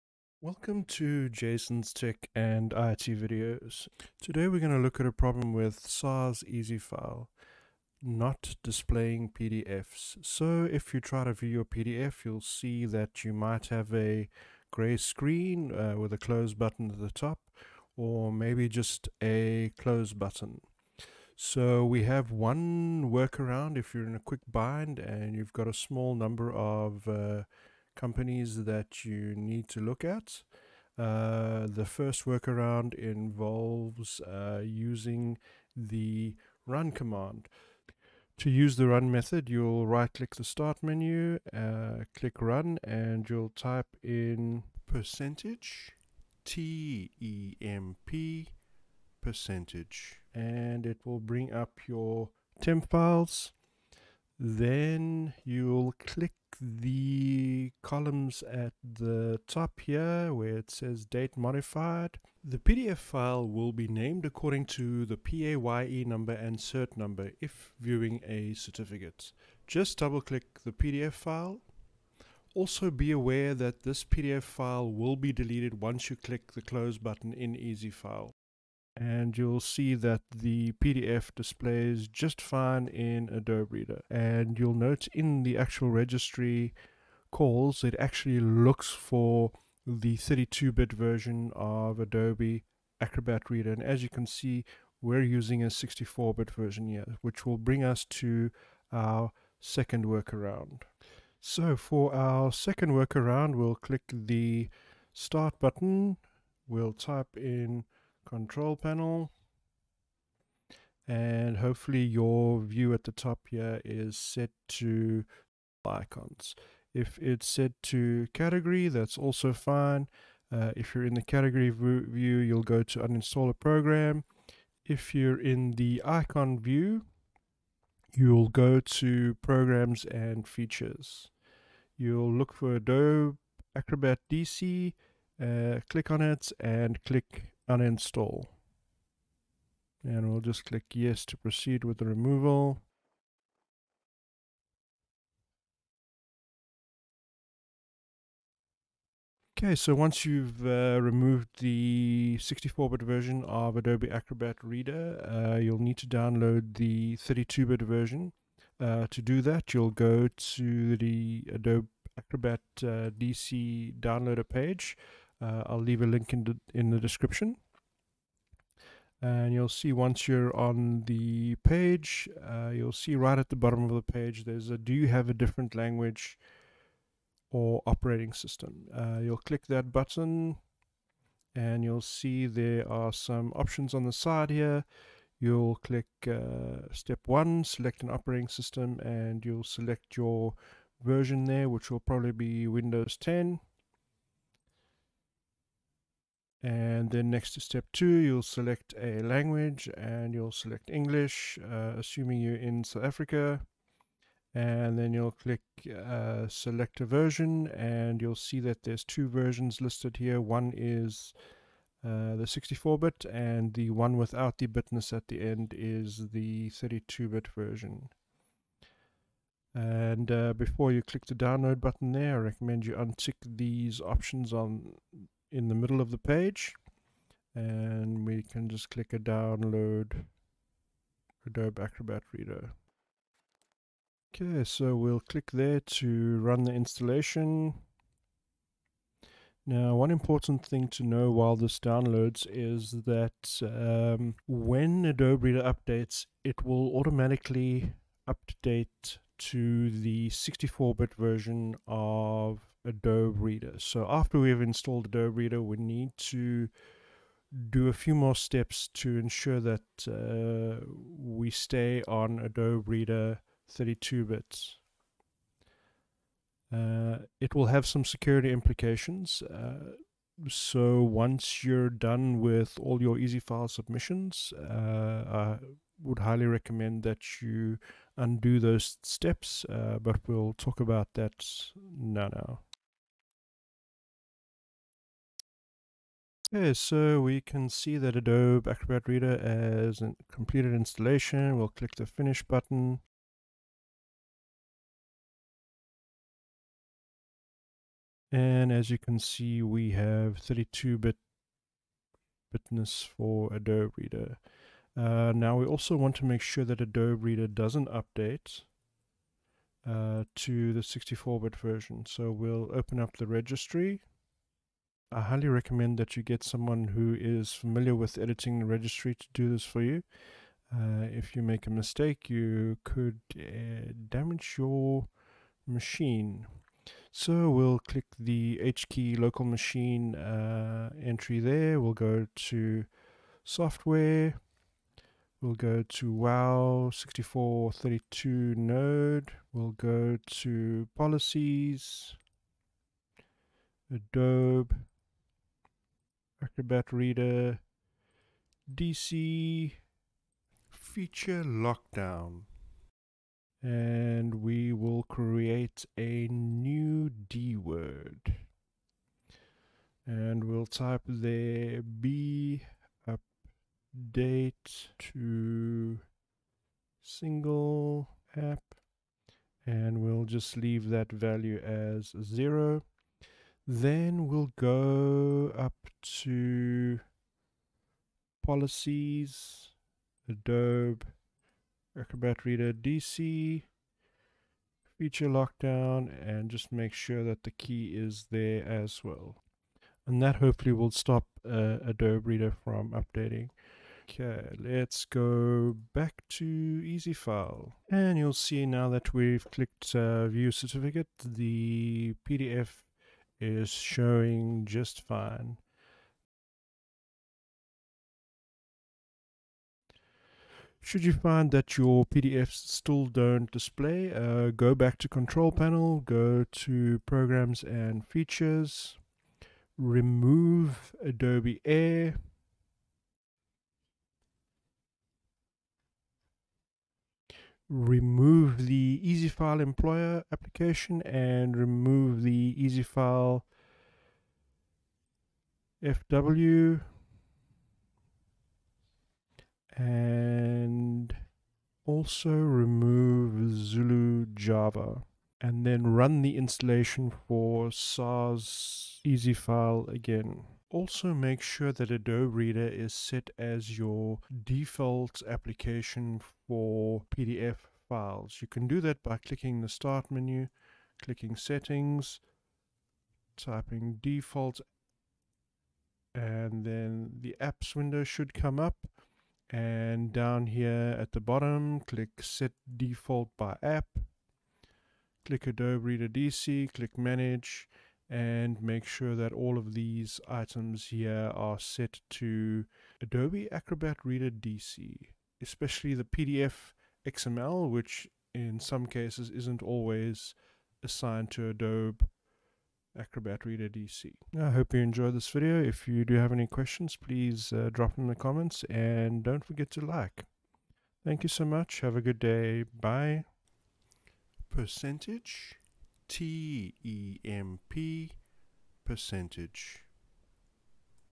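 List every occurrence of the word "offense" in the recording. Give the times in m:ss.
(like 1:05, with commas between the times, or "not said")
not said.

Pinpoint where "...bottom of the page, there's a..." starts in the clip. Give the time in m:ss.
2:53.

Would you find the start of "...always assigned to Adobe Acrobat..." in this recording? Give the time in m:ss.
8:09.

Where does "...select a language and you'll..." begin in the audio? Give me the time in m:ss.
3:18.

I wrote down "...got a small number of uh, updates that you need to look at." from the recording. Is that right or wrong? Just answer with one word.
wrong.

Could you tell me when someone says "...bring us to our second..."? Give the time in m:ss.
1:37.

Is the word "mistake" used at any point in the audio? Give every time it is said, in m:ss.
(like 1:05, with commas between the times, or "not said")
5:21.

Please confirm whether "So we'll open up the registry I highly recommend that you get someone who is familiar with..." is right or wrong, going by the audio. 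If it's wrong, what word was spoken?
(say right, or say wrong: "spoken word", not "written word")
right.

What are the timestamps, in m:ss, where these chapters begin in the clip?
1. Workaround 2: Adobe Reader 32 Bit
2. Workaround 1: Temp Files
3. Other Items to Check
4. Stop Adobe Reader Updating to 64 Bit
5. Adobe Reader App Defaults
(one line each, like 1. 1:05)
1. 1:40
2. 0:25
3. 6:50
4. 5:00
5. 7:30.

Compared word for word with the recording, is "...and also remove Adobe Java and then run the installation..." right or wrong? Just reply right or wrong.
wrong.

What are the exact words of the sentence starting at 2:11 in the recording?
You'll look for Adobe Acrobat DC, uh, click on it and click uninstall.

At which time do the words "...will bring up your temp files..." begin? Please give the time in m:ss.
0:51.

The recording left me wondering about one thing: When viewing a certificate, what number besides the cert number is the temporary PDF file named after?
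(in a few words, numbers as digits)
PAYE number.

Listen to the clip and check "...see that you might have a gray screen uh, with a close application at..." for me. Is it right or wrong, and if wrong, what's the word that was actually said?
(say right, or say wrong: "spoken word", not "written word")
wrong: "button", not "application".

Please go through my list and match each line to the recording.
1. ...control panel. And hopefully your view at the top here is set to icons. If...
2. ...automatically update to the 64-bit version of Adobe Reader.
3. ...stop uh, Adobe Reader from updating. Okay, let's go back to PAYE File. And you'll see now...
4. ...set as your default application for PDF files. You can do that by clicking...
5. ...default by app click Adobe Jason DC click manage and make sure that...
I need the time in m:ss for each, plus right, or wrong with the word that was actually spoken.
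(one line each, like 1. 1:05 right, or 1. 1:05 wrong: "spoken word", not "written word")
1. 1:48 right
2. 4:06 right
3. 6:30 wrong: "Easy", not "PAYE"
4. 7:32 right
5. 7:52 wrong: "Reader", not "Jason".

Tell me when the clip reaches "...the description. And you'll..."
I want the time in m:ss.
2:46.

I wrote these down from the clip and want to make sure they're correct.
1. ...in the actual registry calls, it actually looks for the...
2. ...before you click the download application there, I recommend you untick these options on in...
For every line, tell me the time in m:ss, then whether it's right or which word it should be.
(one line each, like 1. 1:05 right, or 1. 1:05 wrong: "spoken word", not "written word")
1. 1:25 right
2. 3:40 wrong: "button", not "application".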